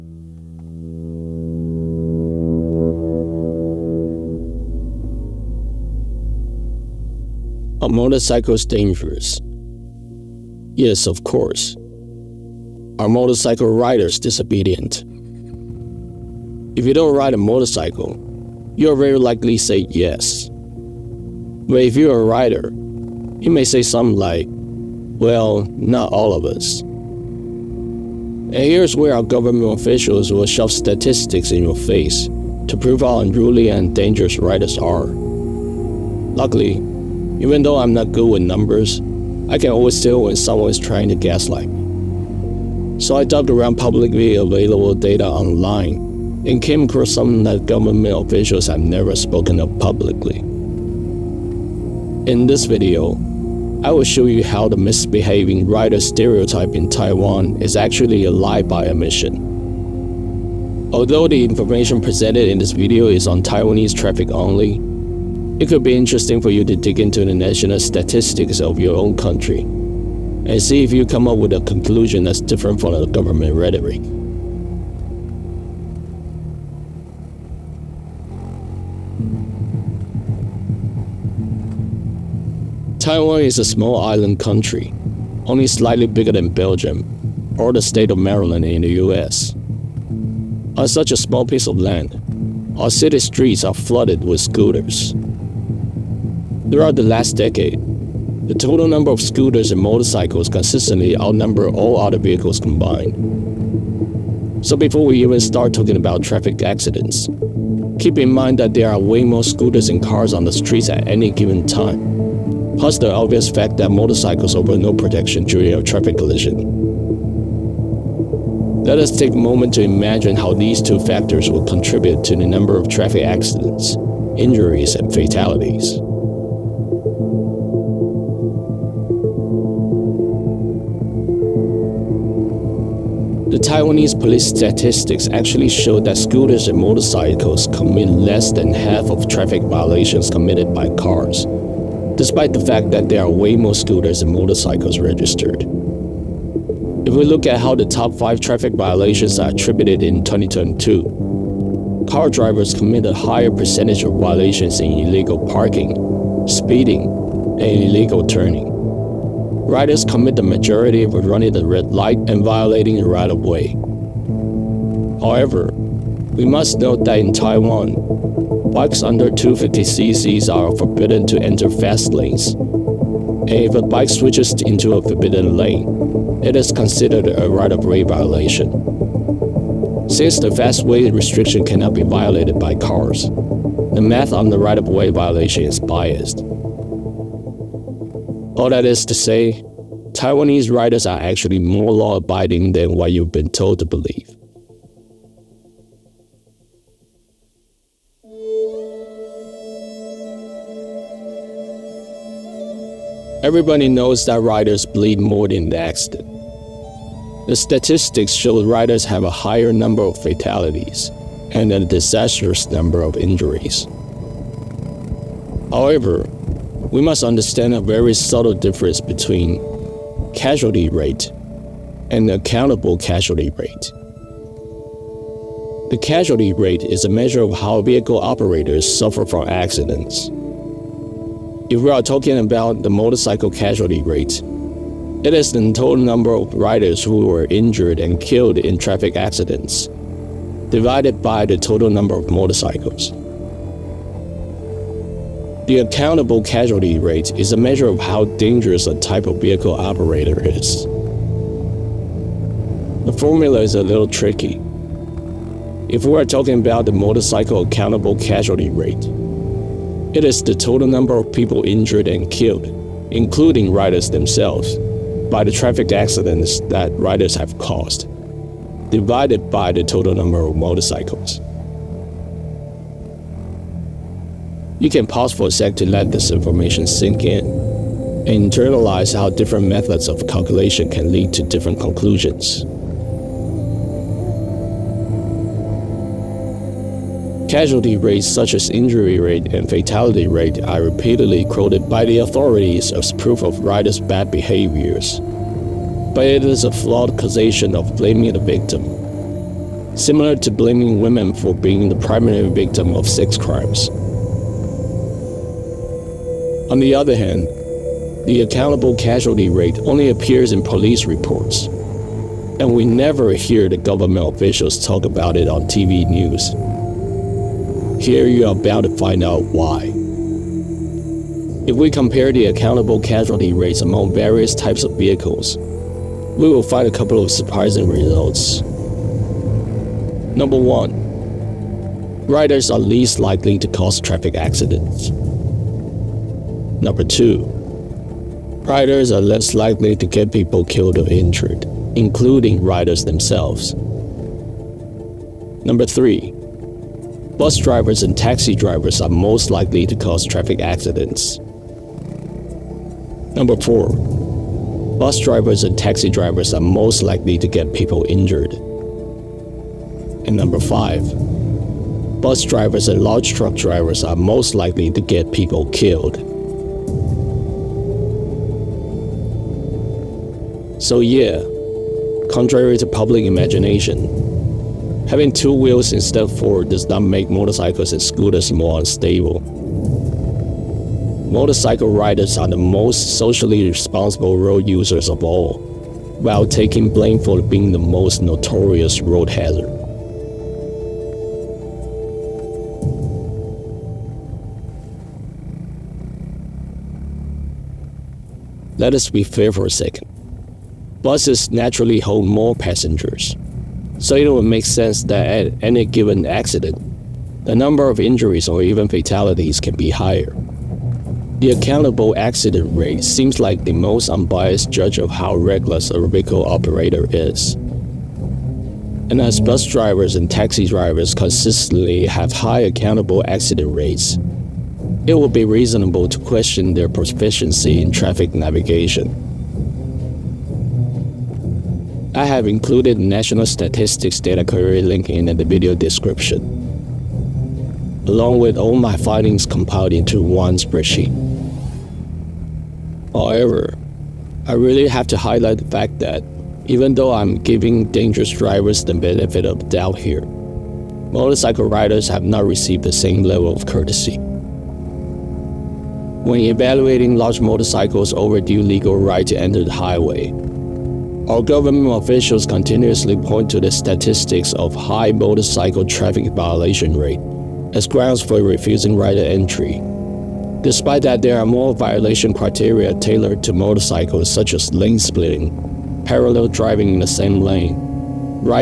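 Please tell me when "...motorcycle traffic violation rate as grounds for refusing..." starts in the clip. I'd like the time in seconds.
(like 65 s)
465 s.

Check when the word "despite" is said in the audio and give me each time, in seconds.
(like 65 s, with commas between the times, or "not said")
142 s, 470 s.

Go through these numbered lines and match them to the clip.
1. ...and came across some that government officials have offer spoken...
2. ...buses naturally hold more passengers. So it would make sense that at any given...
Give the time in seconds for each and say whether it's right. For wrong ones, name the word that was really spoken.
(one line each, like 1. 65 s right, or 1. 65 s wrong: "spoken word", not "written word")
1. 46 s wrong: "never", not "offer"
2. 401 s right.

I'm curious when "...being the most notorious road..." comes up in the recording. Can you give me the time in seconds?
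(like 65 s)
387 s.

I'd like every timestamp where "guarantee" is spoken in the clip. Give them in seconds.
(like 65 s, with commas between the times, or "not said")
not said.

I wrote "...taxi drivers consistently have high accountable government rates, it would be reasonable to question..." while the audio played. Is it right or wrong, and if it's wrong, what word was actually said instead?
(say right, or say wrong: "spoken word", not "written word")
wrong: "accident", not "government".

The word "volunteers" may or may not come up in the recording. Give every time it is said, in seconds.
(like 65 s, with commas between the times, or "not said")
not said.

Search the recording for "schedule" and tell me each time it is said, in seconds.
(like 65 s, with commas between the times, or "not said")
not said.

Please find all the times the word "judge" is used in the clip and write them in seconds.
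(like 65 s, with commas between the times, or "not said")
414 s.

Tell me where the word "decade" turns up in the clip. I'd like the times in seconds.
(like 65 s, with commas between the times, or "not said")
97 s.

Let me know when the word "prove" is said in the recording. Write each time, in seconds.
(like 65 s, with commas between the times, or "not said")
32 s.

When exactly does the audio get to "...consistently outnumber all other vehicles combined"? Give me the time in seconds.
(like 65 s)
100 s.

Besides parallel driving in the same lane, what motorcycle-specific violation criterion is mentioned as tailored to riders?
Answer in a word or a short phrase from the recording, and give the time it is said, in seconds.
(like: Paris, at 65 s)
lane splitting, at 474 s.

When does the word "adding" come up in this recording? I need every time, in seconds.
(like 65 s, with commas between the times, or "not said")
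not said.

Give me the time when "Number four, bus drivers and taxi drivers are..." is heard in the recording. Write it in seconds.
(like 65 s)
353 s.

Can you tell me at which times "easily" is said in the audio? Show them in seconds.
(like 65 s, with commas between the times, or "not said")
not said.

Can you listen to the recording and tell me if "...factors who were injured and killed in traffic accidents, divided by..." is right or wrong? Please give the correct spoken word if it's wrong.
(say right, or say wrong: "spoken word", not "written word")
wrong: "riders", not "factors".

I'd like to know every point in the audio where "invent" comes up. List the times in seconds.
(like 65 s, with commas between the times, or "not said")
not said.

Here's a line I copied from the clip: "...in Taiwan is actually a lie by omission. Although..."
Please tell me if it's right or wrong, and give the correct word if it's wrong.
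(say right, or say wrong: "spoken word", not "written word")
right.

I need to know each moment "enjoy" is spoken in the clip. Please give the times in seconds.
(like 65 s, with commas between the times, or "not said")
not said.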